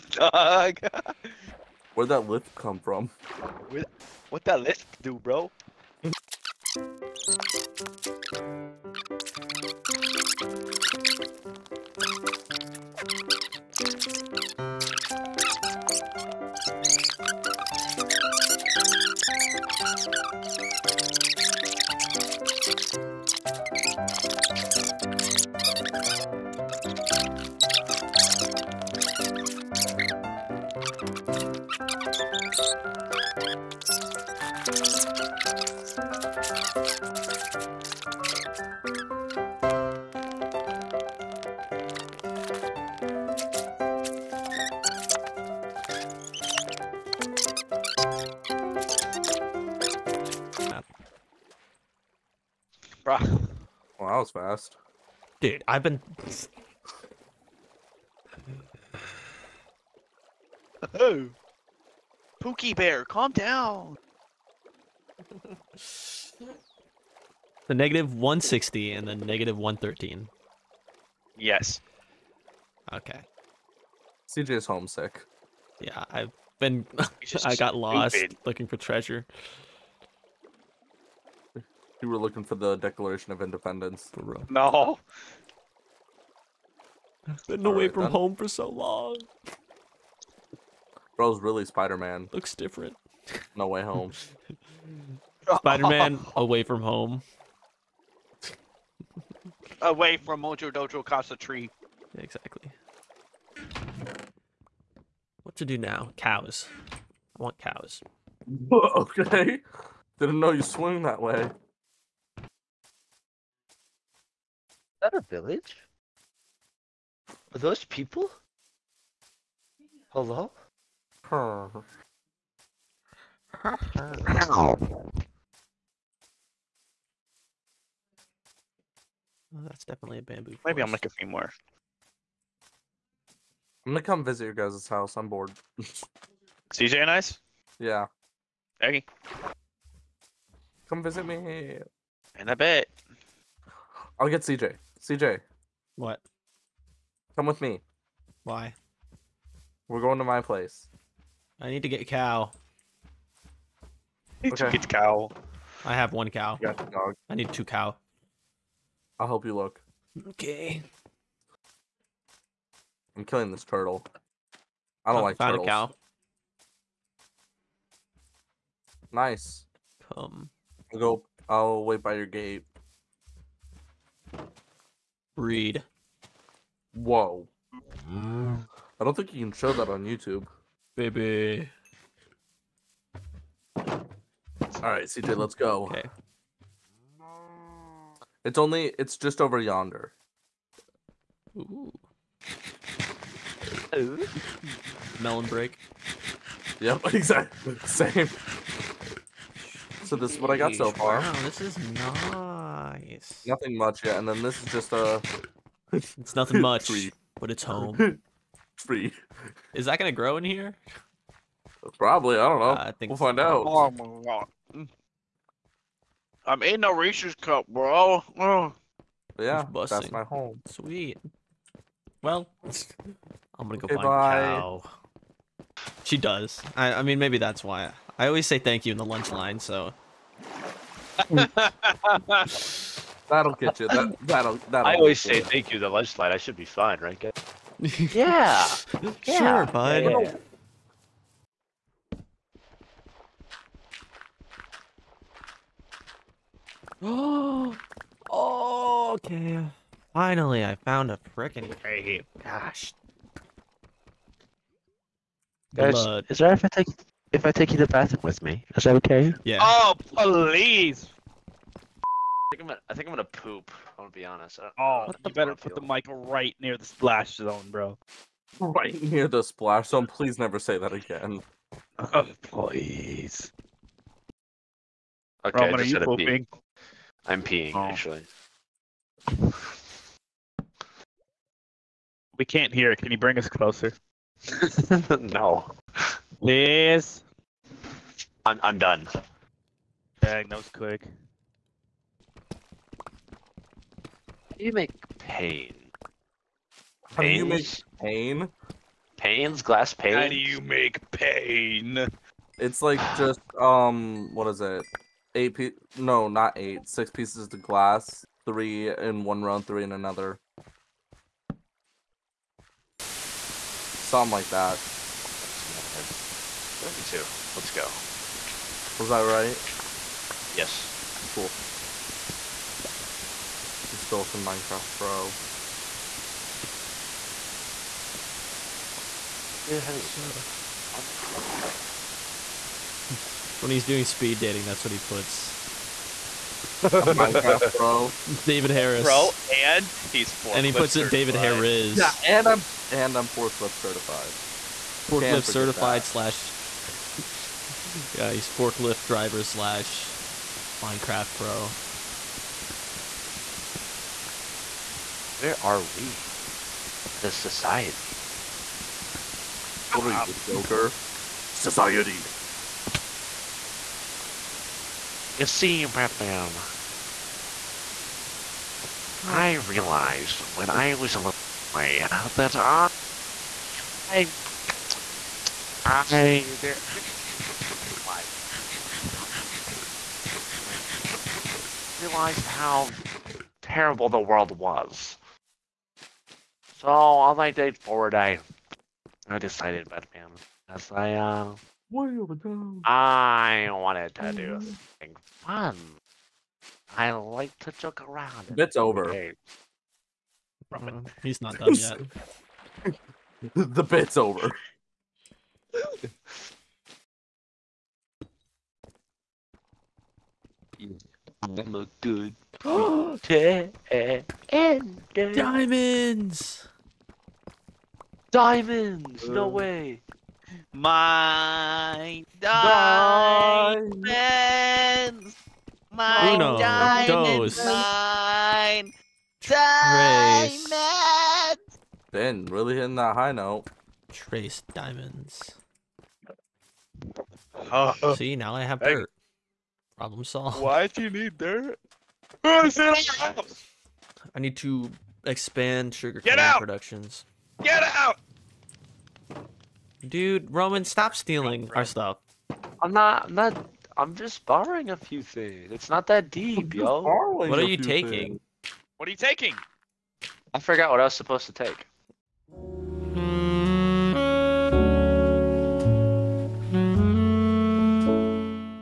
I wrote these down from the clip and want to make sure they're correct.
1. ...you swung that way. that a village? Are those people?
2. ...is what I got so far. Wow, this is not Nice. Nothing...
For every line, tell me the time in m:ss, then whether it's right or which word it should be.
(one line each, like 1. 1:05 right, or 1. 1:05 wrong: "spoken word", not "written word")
1. 1:50 right
2. 3:20 right.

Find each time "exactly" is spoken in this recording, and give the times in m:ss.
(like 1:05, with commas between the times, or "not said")
1:42, 3:17.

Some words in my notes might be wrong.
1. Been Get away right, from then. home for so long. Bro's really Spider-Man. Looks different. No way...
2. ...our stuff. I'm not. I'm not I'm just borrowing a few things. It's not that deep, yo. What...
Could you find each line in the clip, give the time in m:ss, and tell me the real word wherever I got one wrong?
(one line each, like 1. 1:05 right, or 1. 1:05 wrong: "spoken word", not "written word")
1. 1:27 wrong: "All", not "Get"
2. 7:31 right.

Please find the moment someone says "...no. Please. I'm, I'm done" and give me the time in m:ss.
4:45.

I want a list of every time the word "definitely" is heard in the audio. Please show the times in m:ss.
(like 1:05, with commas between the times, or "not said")
2:09.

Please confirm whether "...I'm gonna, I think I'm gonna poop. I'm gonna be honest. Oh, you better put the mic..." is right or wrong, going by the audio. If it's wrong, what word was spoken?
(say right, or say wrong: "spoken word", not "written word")
right.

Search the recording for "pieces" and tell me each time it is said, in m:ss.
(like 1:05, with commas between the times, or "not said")
5:07.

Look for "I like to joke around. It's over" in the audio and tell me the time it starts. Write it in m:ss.
6:36.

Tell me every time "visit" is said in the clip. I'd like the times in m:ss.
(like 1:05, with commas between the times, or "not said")
2:14, 2:21.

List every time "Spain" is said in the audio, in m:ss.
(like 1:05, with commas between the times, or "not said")
not said.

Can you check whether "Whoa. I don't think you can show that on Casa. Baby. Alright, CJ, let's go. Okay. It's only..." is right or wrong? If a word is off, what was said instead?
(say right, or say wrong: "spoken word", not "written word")
wrong: "YouTube", not "Casa".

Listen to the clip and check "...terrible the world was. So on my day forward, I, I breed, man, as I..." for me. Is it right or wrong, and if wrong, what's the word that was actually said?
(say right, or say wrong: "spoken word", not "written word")
wrong: "decided", not "breed".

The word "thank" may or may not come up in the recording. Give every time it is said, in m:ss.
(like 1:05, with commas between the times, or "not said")
3:48, 3:55.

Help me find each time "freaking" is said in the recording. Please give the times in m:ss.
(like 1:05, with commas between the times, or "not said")
4:11.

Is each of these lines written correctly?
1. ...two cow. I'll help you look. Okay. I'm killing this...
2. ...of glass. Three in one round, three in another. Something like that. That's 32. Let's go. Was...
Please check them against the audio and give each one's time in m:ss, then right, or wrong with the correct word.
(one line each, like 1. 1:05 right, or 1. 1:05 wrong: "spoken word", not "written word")
1. 2:37 right
2. 5:07 right.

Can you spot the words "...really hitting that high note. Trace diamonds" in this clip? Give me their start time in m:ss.
7:12.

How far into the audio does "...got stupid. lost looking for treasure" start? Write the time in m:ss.
1:17.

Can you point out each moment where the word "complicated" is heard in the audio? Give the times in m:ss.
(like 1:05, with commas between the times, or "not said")
not said.